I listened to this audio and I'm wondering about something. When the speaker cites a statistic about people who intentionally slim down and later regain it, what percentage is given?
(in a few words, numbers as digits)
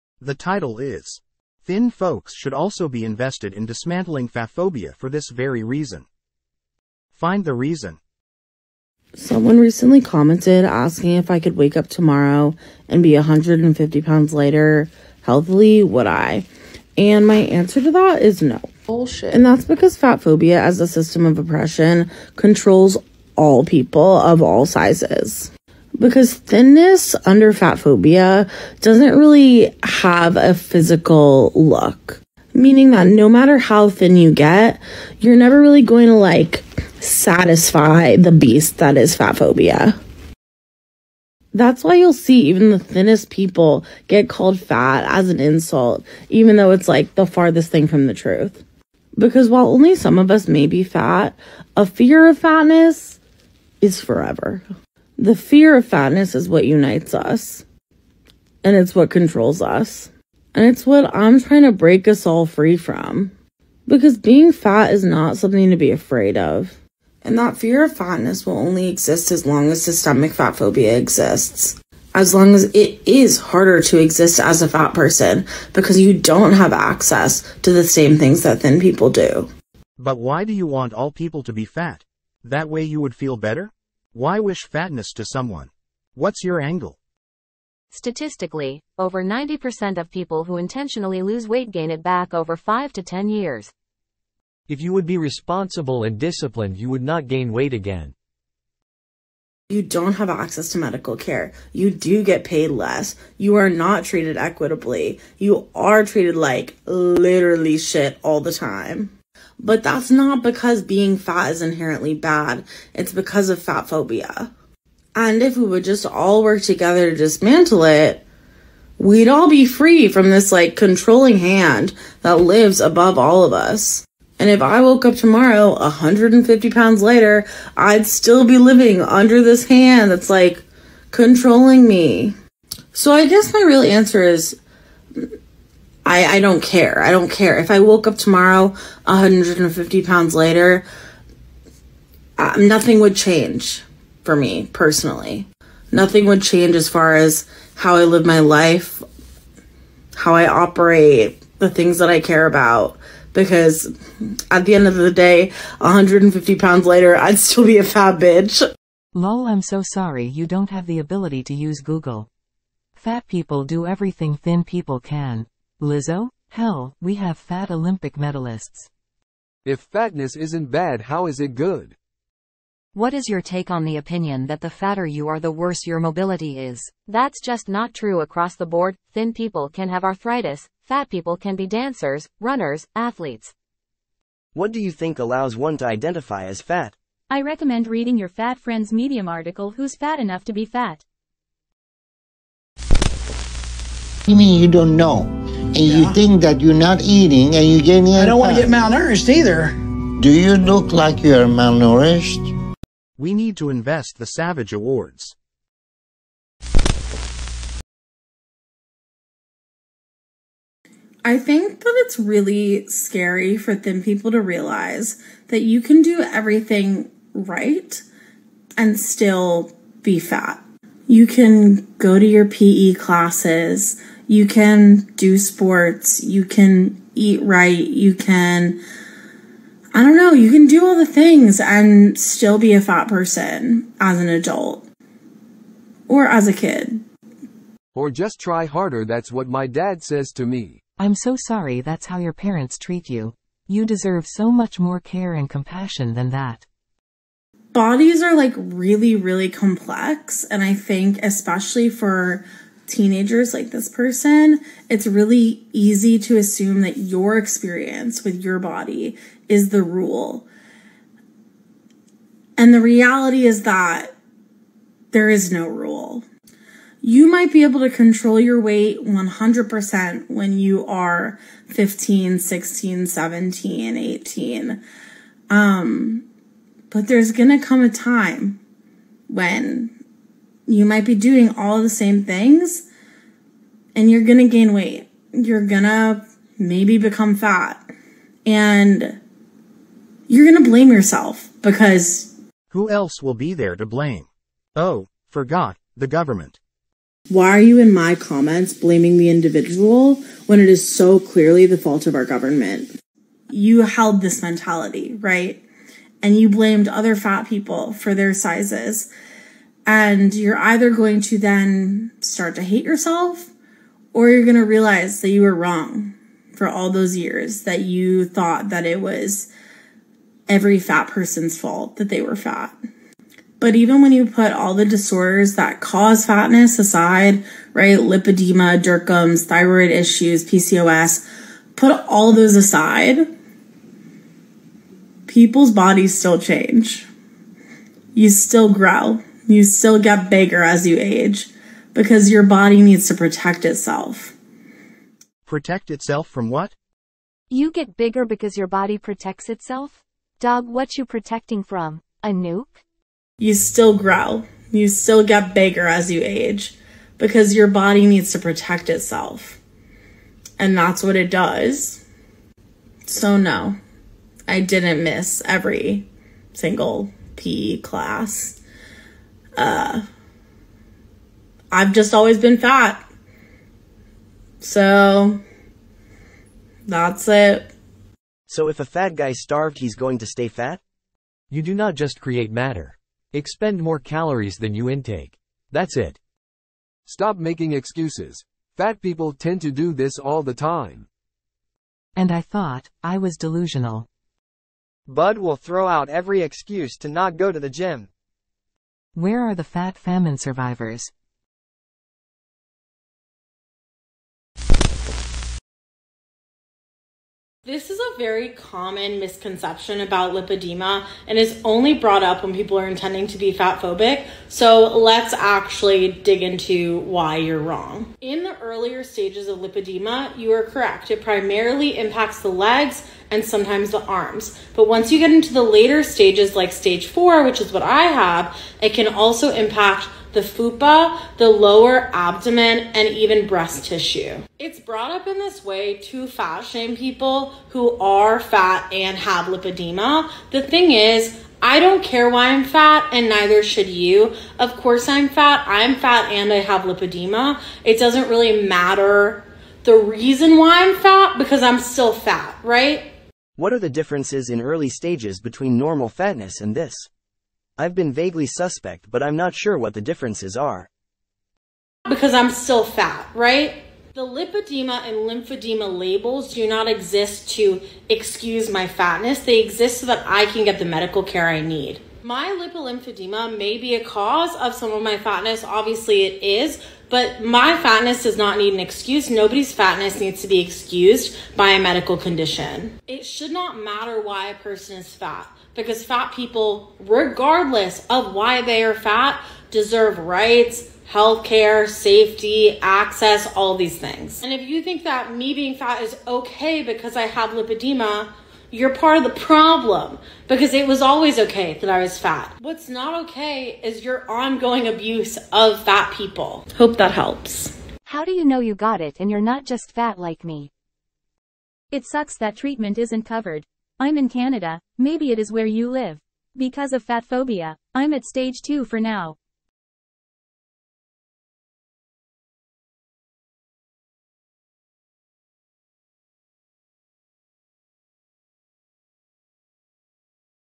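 over 90%.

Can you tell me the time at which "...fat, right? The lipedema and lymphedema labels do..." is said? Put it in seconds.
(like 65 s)
462 s.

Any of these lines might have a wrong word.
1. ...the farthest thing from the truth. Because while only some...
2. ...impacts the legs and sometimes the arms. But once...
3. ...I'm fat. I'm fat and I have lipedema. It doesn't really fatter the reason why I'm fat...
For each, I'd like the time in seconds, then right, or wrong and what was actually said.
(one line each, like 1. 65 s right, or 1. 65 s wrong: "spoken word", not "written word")
1. 47 s right
2. 421 s right
3. 445 s wrong: "matter", not "fatter".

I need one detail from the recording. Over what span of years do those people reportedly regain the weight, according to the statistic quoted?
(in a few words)
5 to 10 years.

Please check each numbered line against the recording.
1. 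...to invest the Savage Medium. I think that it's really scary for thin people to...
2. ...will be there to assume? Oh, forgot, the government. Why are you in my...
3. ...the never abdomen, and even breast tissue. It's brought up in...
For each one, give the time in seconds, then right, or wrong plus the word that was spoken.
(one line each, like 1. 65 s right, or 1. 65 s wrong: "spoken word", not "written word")
1. 203 s wrong: "Awards", not "Medium"
2. 293 s wrong: "blame", not "assume"
3. 431 s wrong: "lower", not "never".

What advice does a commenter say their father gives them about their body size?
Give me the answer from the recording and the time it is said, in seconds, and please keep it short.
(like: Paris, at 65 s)
Just try harder, at 238 s.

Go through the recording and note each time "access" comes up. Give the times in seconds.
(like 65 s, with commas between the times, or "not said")
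76 s, 100 s, 492 s.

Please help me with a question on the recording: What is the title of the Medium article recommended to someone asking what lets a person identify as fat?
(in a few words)
Who's Fat Enough to Be Fat?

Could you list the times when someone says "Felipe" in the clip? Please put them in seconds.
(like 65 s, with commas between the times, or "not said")
not said.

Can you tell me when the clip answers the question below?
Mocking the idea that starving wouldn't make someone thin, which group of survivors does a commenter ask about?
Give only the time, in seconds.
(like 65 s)
399 s.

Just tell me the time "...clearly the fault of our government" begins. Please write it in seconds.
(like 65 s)
301 s.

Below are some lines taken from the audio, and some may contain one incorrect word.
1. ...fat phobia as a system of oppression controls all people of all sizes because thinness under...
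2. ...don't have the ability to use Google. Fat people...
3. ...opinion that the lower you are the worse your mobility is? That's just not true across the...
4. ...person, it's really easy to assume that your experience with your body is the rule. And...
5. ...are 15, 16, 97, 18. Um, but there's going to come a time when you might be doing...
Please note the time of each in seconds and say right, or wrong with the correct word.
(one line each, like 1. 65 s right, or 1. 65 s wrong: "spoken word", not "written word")
1. 19 s right
2. 160 s right
3. 173 s wrong: "fatter", not "lower"
4. 253 s right
5. 270 s wrong: "17", not "97".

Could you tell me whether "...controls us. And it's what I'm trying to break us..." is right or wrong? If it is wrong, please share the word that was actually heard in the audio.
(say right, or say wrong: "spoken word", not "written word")
right.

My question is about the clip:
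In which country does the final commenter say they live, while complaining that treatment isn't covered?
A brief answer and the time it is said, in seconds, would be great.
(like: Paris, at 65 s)
Canada, at 514 s.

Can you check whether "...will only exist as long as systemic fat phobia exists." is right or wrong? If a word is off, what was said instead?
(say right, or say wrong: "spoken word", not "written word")
right.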